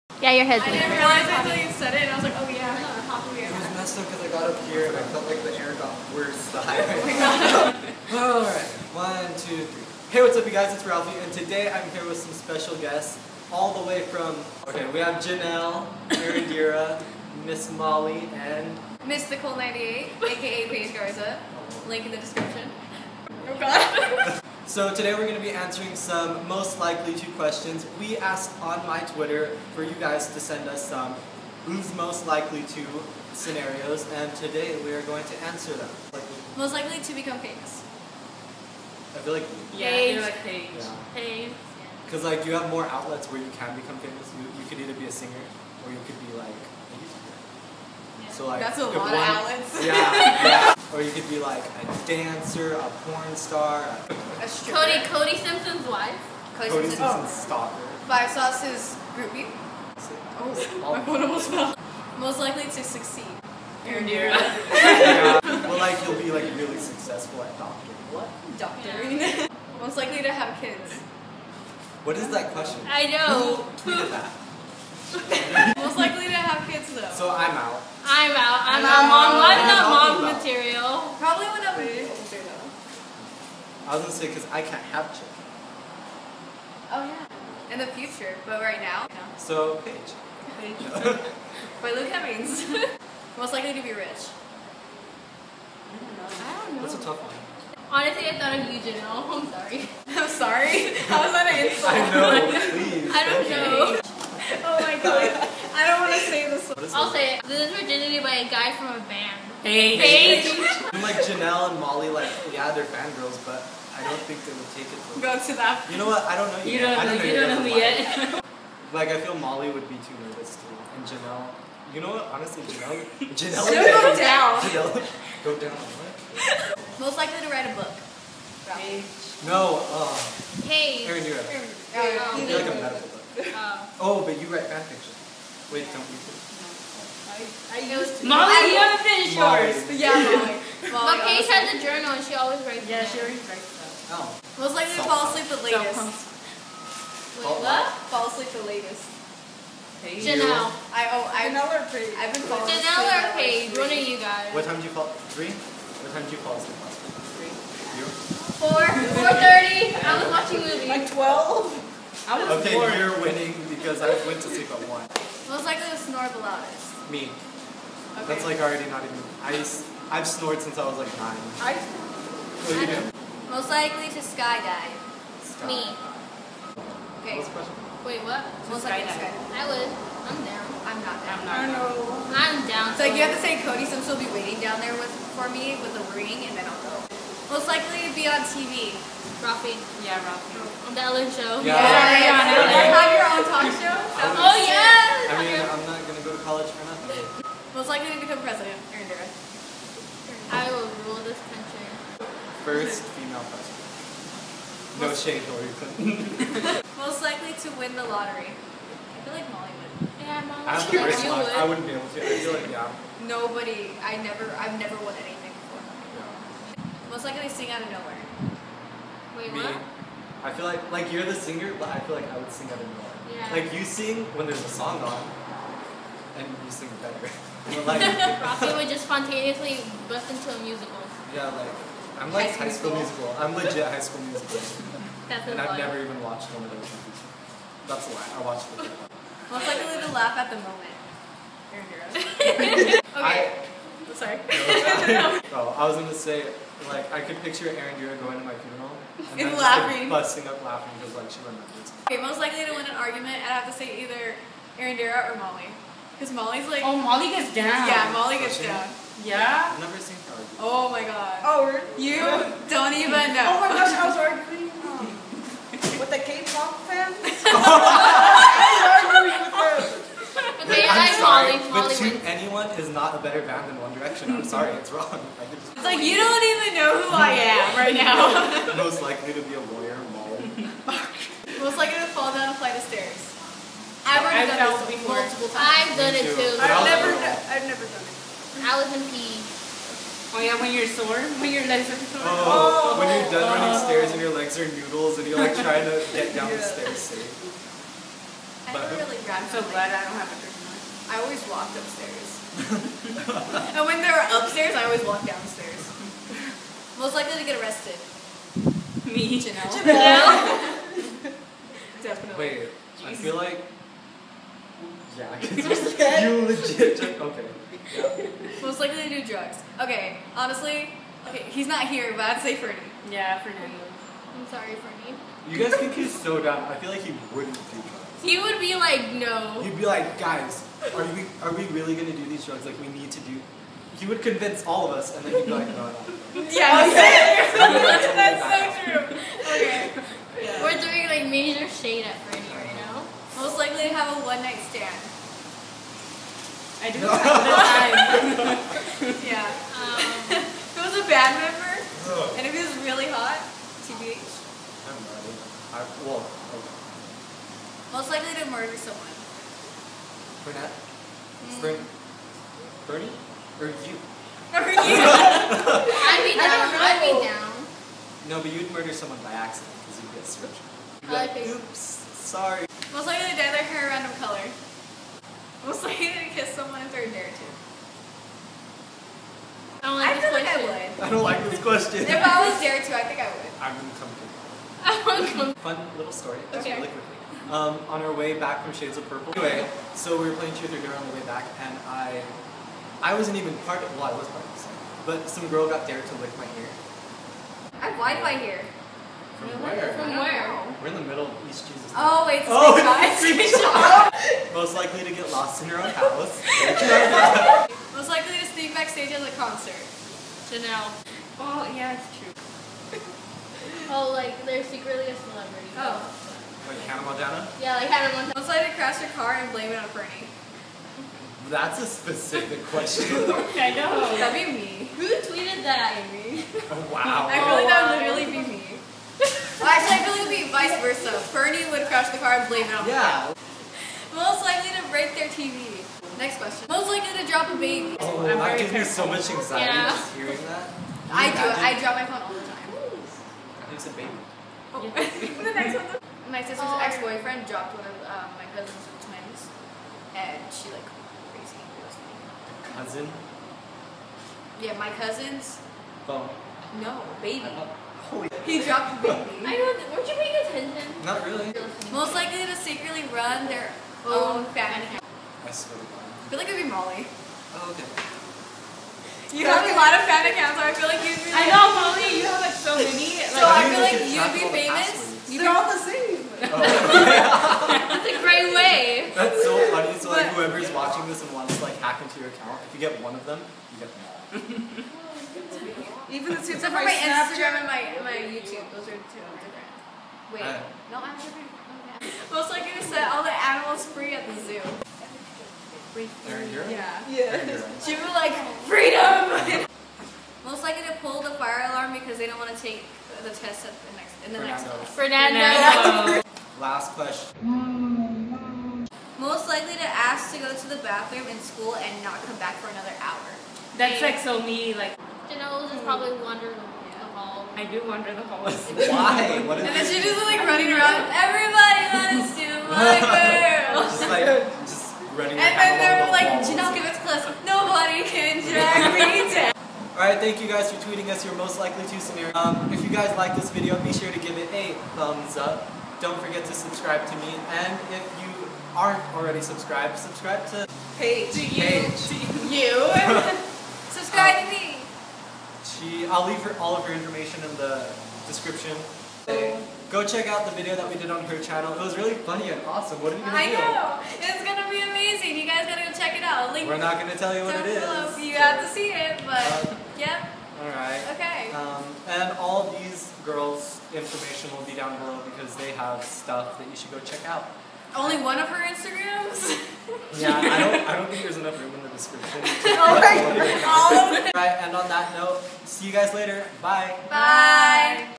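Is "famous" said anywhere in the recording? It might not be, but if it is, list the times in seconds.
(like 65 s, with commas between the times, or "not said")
37 s, 43 s, 474 s.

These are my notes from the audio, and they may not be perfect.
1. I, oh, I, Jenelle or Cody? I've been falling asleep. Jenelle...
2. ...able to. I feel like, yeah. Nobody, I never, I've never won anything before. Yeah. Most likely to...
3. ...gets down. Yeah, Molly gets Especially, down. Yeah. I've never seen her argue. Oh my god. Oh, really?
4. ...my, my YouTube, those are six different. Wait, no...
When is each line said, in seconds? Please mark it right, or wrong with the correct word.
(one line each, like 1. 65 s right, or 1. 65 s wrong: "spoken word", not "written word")
1. 150 s wrong: "Paige", not "Cody"
2. 211 s right
3. 257 s right
4. 487 s wrong: "two", not "six".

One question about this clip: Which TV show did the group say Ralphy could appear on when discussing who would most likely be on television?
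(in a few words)
The Ellen Show.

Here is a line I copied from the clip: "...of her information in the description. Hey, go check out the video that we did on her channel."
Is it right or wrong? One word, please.
right.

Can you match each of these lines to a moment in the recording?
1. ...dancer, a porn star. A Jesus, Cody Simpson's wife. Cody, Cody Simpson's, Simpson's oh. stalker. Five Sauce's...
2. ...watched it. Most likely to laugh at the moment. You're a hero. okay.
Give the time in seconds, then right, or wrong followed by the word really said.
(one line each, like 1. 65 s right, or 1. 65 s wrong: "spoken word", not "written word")
1. 52 s wrong: "Cody", not "Jesus"
2. 238 s right.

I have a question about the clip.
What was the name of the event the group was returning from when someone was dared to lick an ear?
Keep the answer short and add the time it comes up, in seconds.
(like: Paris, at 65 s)
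Shades of Purple, at 388 s.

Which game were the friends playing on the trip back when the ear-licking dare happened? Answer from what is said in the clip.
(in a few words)
Cheer 3 Glitter.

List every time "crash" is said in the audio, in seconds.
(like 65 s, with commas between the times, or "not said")
418 s, 431 s.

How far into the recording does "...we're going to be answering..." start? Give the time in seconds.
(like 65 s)
25 s.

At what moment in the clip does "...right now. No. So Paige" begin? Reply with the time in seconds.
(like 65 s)
88 s.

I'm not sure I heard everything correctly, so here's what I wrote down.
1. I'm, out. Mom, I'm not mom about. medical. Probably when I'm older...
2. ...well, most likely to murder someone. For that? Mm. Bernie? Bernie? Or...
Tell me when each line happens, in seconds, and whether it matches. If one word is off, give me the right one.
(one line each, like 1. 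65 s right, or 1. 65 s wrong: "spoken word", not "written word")
1. 78 s wrong: "material", not "medical"
2. 356 s right.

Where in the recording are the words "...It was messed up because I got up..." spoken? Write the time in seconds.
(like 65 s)
3 s.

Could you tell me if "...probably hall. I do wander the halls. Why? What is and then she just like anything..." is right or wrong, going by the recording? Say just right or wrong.
wrong.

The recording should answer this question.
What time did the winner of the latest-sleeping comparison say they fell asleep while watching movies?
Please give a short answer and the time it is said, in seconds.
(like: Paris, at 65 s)
4:30, at 159 s.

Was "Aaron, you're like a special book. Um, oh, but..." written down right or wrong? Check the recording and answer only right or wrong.
wrong.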